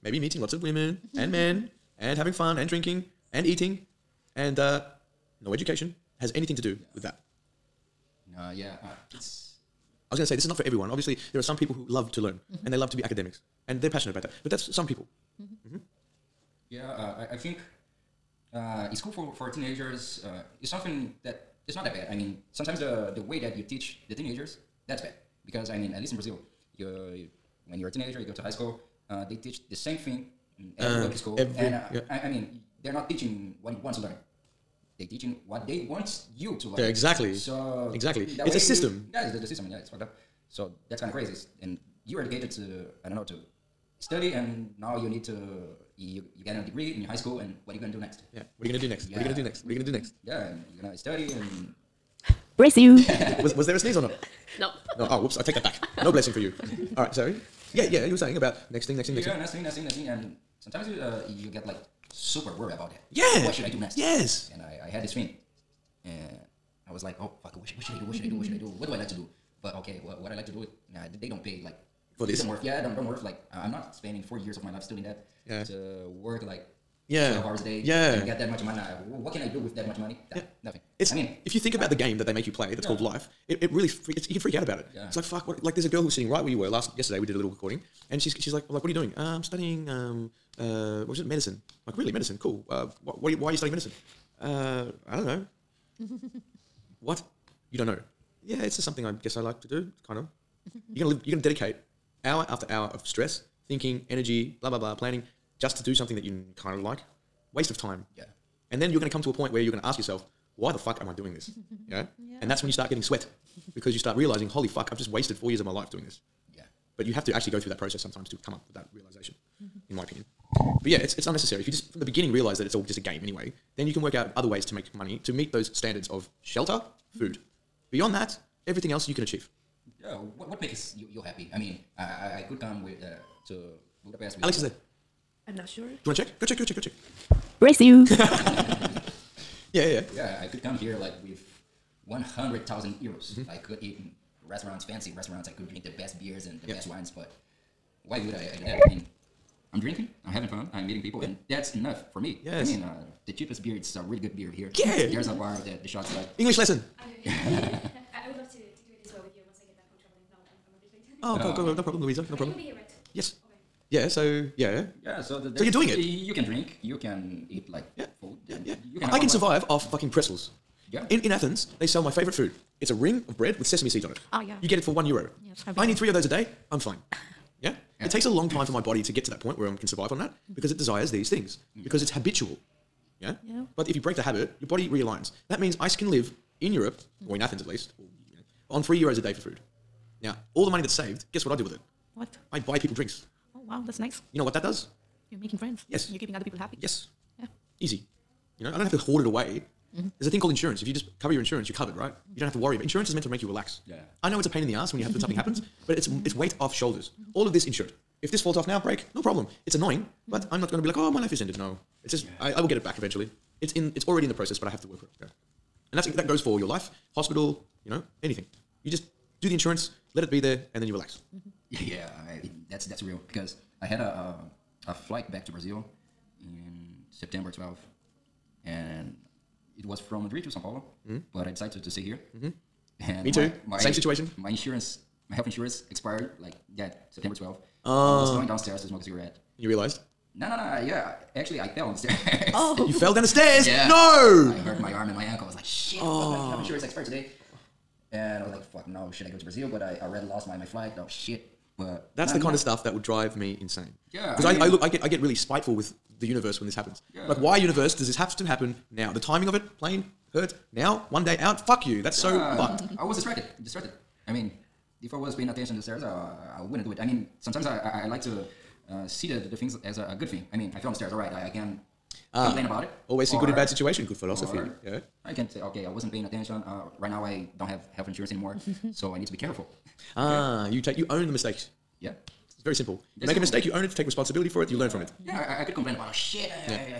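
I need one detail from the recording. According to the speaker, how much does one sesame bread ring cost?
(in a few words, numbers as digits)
1 euro.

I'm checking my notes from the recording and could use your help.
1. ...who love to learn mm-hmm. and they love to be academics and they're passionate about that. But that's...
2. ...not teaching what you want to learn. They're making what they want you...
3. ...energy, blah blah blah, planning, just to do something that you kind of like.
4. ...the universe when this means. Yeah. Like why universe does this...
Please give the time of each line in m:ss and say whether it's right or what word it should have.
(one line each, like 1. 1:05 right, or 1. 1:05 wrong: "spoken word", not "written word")
1. 0:11 right
2. 0:32 wrong: "teaching", not "making"
3. 1:44 right
4. 4:16 wrong: "happens", not "means".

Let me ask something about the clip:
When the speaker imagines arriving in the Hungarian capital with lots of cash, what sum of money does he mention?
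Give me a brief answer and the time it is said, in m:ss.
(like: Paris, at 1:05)
100,000 euros, at 2:22.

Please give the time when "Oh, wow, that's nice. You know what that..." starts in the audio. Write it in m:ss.
3:13.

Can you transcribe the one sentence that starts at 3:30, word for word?
but I'm not going to be like, "Oh, my life is ended." No.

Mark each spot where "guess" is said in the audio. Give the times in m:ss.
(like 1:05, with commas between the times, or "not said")
1:39, 3:11.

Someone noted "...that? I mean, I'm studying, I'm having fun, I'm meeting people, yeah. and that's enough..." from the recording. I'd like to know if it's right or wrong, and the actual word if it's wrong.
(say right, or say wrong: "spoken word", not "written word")
wrong: "drinking", not "studying".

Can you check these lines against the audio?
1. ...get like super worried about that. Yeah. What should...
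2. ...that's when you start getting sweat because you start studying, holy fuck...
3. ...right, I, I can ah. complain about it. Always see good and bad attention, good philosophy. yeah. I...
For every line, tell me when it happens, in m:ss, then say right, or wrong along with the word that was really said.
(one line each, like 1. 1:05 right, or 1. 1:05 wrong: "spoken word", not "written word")
1. 1:01 right
2. 1:52 wrong: "realizing", not "studying"
3. 4:31 wrong: "situation", not "attention".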